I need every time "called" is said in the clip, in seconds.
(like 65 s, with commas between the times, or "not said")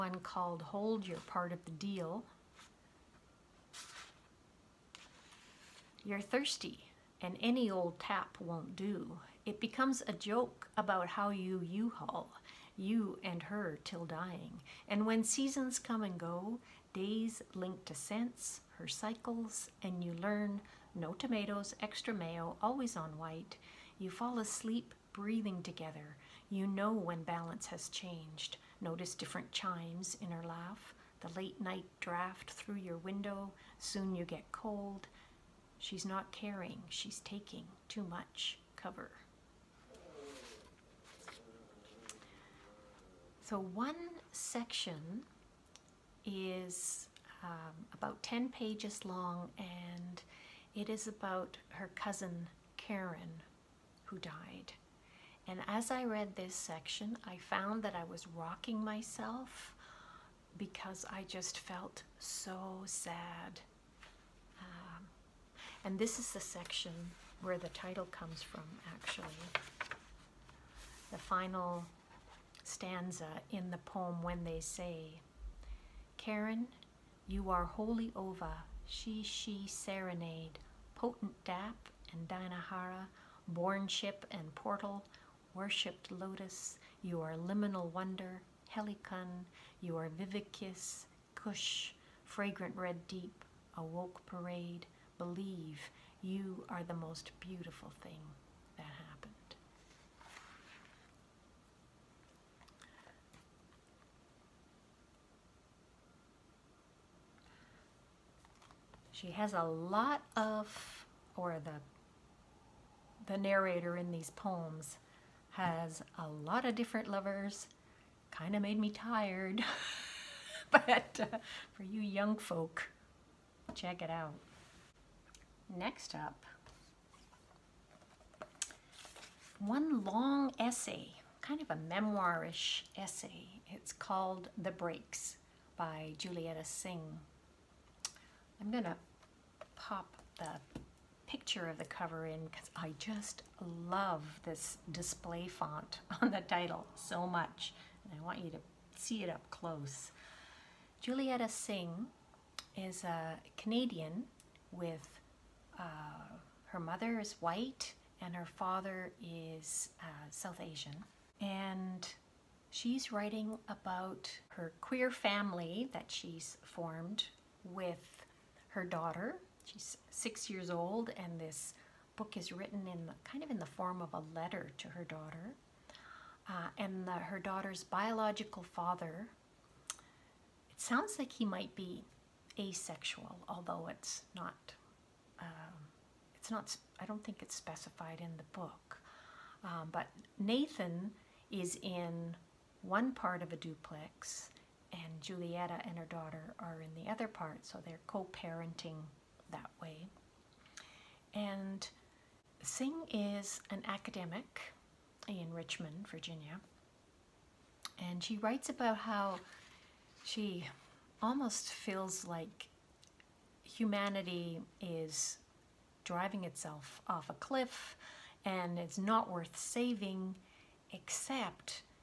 0 s, 133 s.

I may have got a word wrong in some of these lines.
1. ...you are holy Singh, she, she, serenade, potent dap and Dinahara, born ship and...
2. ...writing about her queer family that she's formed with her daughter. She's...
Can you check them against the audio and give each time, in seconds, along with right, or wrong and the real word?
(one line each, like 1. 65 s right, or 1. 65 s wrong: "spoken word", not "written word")
1. 77 s wrong: "Ova", not "Singh"
2. 163 s right.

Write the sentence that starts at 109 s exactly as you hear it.
She has a lot of, or the, the narrator in these poems has a lot of different lovers.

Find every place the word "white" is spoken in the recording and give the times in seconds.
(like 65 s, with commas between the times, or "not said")
23 s, 157 s.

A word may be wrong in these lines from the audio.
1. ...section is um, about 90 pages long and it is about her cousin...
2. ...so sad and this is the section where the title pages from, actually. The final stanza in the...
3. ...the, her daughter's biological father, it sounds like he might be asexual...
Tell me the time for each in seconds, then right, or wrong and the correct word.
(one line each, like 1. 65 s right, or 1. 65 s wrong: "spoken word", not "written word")
1. 44 s wrong: "10", not "90"
2. 62 s wrong: "comes", not "pages"
3. 177 s right.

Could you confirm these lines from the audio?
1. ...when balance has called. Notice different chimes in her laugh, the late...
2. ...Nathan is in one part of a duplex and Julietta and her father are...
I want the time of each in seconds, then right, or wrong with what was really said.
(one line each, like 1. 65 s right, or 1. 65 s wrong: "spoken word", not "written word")
1. 26 s wrong: "changed", not "called"
2. 190 s wrong: "daughter", not "father".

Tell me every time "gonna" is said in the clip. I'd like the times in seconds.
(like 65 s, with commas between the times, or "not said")
138 s.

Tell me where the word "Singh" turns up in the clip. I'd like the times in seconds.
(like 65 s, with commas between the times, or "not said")
136 s, 151 s, 202 s.